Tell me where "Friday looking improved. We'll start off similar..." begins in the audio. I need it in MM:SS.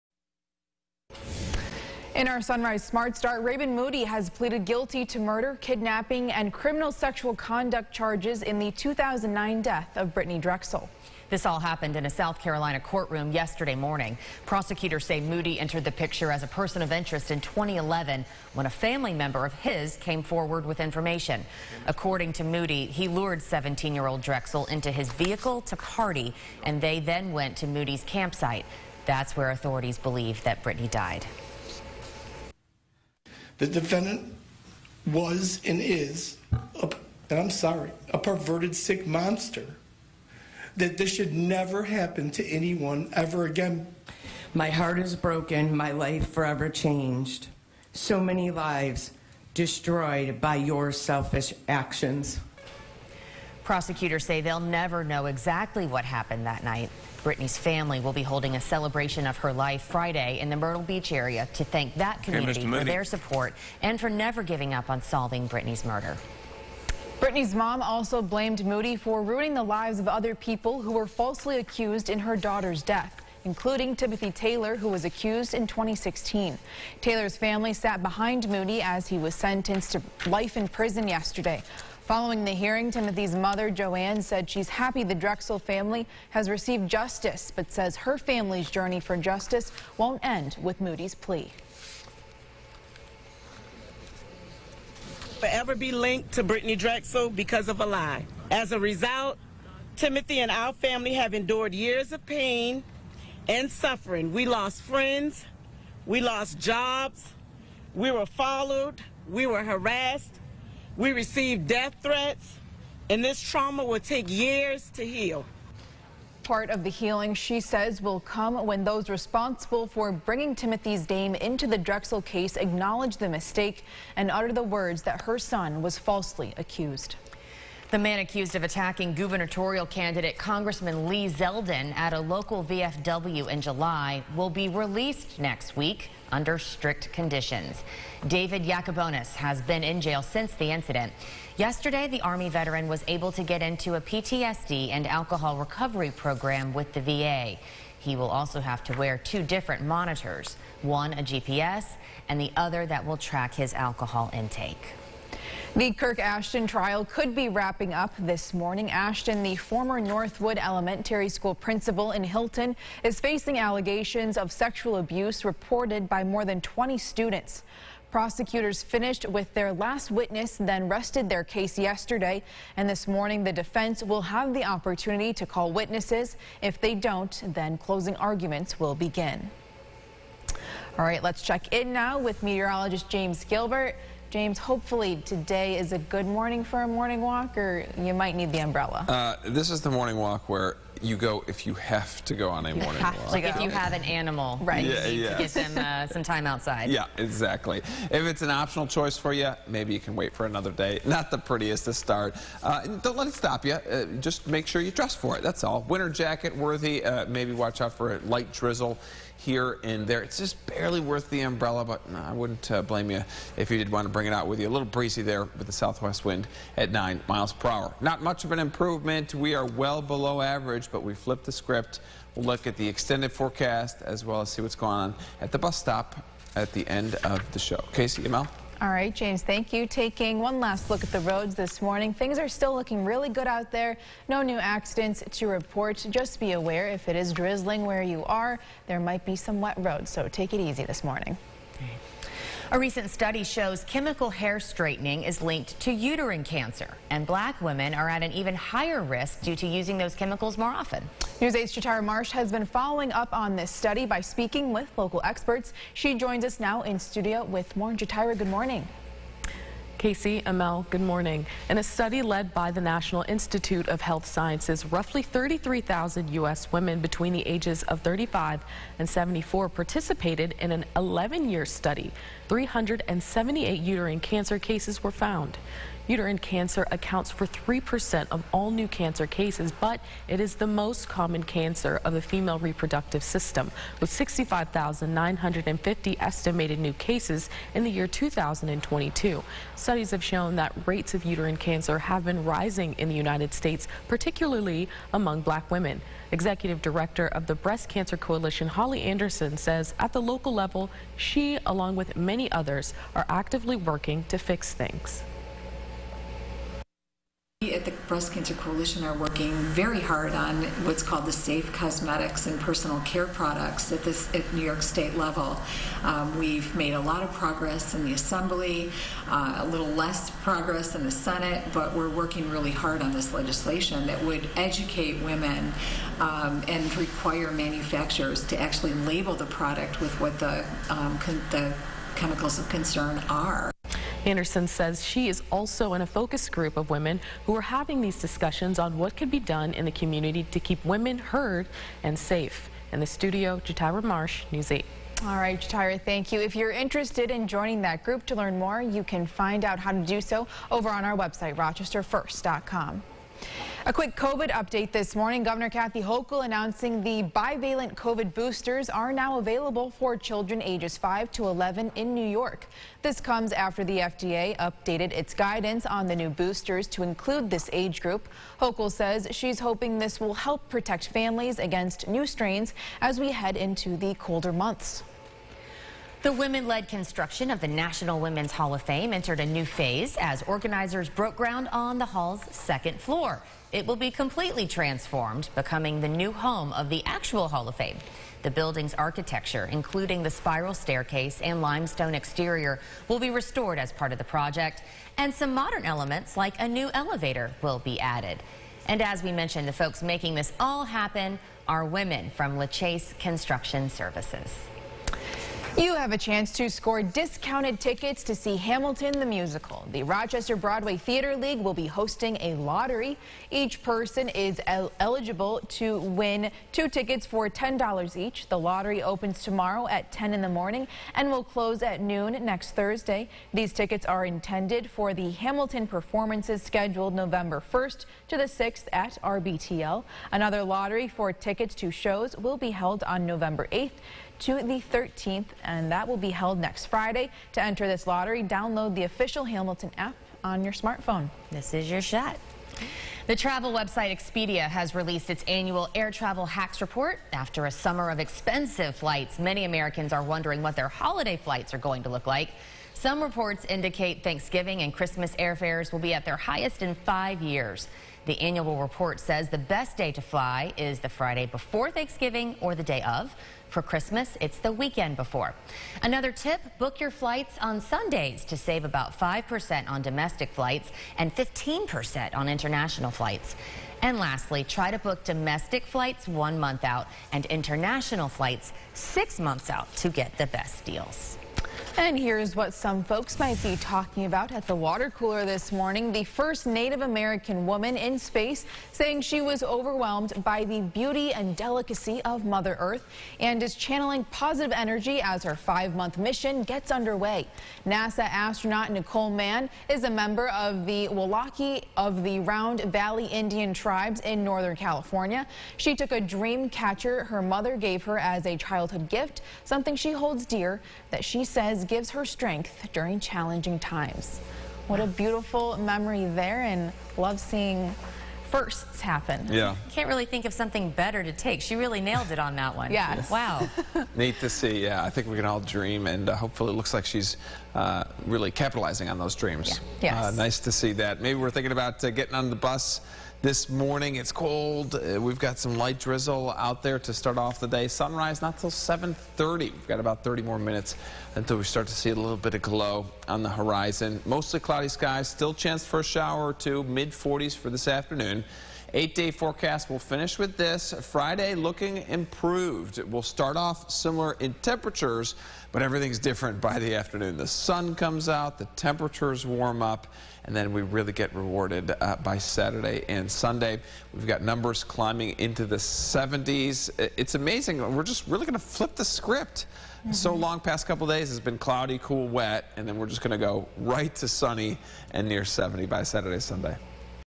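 09:11.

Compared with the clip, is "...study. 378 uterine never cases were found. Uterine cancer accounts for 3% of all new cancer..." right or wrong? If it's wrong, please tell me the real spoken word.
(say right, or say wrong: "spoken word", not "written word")
wrong: "cancer", not "never".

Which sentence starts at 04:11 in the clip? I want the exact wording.
News 8's Chatara Marsh has been following up on this study by speaking with local experts.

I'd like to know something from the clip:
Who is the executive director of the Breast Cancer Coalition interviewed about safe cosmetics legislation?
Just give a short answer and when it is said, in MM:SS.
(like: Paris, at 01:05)
Holly Anderson, at 04:58.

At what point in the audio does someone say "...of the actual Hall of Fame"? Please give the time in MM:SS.
06:26.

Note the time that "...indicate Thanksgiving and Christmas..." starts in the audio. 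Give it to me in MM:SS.
07:33.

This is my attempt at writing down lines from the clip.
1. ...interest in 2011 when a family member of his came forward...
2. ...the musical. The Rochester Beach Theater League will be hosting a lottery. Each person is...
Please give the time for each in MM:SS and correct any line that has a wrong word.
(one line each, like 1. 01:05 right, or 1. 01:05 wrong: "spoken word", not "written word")
1. 00:16 right
2. 06:49 wrong: "Broadway", not "Beach".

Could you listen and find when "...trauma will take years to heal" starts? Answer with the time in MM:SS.
01:53.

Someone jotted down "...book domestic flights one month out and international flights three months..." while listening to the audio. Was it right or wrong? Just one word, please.
wrong.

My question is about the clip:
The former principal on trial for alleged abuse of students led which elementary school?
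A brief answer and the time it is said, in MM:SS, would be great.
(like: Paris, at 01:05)
Northwood Elementary School, at 02:40.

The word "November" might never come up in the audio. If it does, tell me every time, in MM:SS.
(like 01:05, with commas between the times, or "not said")
07:07, 07:13.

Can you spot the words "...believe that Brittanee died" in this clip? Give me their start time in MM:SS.
00:29.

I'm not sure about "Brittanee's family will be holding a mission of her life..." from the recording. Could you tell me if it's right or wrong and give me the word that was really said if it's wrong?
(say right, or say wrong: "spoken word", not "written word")
wrong: "celebration", not "mission".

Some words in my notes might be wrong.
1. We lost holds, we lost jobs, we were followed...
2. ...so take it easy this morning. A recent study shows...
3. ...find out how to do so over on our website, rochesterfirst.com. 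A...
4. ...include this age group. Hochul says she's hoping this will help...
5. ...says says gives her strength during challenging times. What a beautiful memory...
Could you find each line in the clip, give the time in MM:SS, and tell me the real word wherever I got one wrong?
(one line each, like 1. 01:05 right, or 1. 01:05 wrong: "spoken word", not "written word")
1. 01:44 wrong: "friends", not "holds"
2. 04:00 right
3. 05:49 right
4. 06:07 right
5. 08:31 right.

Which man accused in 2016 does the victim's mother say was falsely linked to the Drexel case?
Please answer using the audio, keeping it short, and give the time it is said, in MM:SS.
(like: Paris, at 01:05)
Timothy Taylor, at 01:13.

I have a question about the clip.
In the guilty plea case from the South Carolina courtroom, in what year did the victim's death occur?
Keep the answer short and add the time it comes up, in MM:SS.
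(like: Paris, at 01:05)
2009, at 00:08.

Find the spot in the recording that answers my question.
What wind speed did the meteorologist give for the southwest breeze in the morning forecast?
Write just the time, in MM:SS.
03:36.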